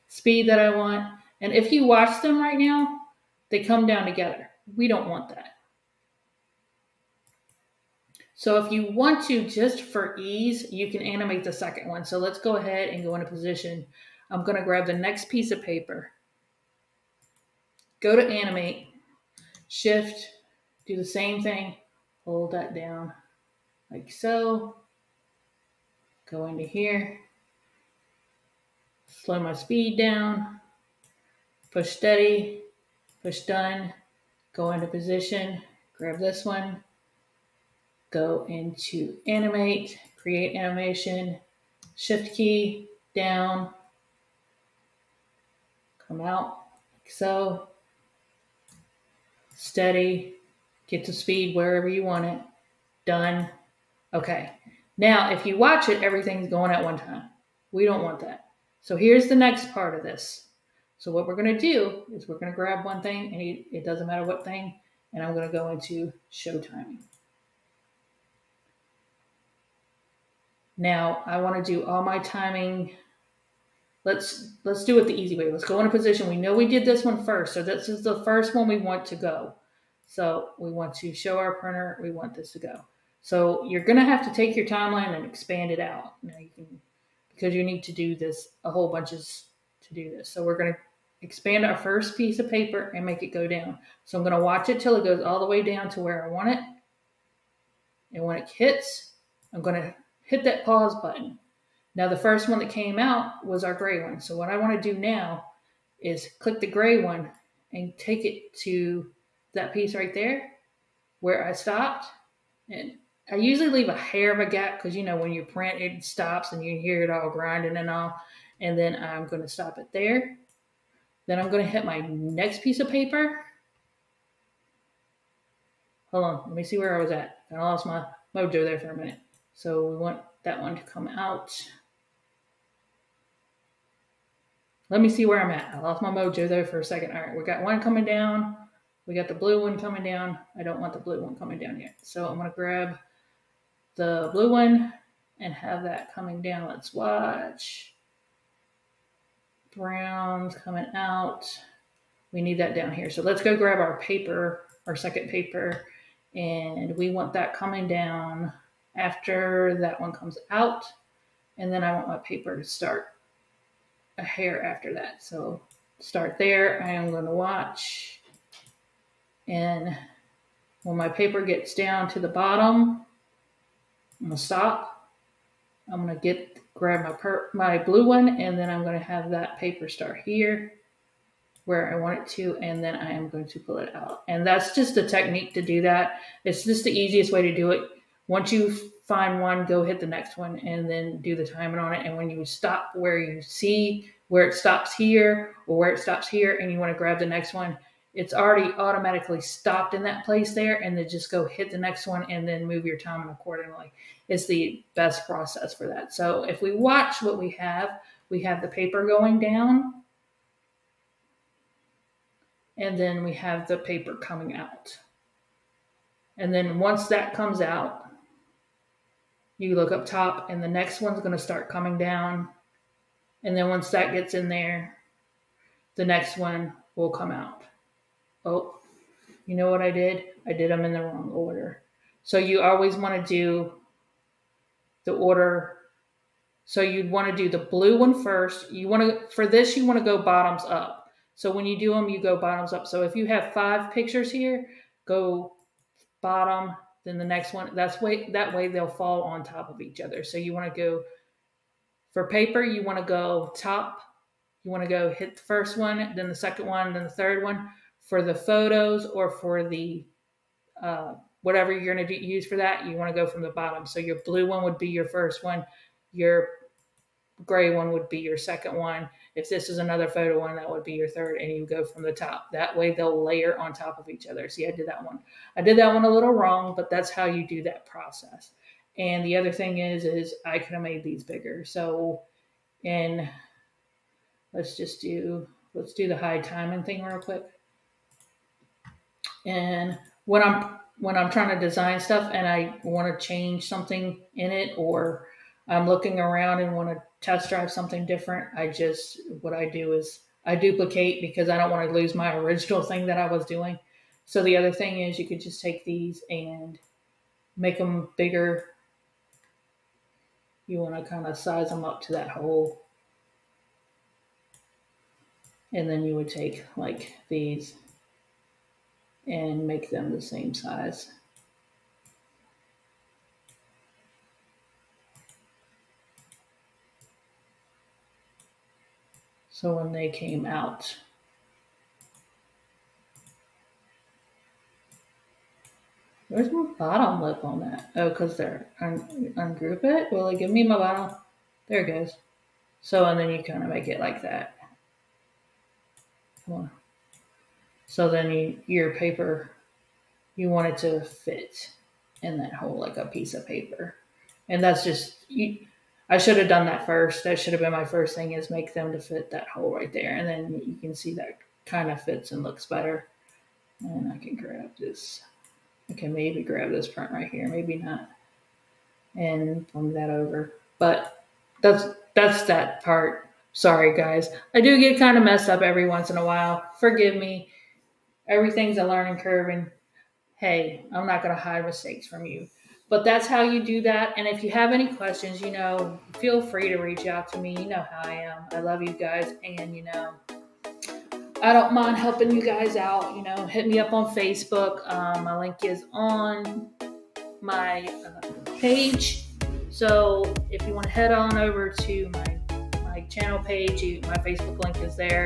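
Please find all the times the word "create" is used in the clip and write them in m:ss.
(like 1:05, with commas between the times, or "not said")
0:40.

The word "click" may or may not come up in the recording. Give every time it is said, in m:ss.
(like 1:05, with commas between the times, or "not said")
1:46.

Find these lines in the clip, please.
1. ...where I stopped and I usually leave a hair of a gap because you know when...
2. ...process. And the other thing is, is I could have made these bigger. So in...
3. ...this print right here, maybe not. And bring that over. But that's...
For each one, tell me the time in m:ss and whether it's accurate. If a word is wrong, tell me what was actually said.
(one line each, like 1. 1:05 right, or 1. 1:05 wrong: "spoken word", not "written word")
1. 1:51 right
2. 4:37 right
3. 6:06 right.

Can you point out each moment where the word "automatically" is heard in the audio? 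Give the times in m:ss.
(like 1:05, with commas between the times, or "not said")
3:18.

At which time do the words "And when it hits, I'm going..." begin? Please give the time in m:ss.
1:38.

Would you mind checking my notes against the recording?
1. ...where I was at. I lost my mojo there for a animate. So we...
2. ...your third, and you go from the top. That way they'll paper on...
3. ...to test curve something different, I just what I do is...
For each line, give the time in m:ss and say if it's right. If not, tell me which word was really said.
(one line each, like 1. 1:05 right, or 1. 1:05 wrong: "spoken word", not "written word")
1. 2:06 wrong: "minute", not "animate"
2. 4:30 wrong: "layer", not "paper"
3. 4:56 wrong: "drive", not "curve".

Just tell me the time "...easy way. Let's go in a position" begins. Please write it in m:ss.
1:15.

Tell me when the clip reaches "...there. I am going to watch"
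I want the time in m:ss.
2:46.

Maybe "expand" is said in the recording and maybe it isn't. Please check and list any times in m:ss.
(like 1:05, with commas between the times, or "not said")
1:25, 1:31.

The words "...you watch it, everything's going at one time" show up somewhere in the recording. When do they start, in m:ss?
0:55.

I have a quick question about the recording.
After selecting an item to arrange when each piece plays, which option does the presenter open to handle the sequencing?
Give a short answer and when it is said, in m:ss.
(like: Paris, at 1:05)
show timing, at 1:06.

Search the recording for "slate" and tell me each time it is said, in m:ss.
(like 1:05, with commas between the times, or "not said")
not said.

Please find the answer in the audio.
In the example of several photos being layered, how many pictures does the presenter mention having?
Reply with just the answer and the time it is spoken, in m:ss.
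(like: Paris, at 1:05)
5, at 4:03.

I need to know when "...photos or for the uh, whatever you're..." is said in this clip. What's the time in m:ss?
4:18.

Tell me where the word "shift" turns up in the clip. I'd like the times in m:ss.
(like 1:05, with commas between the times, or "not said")
0:19, 0:41.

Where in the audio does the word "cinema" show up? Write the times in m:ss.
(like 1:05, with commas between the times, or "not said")
not said.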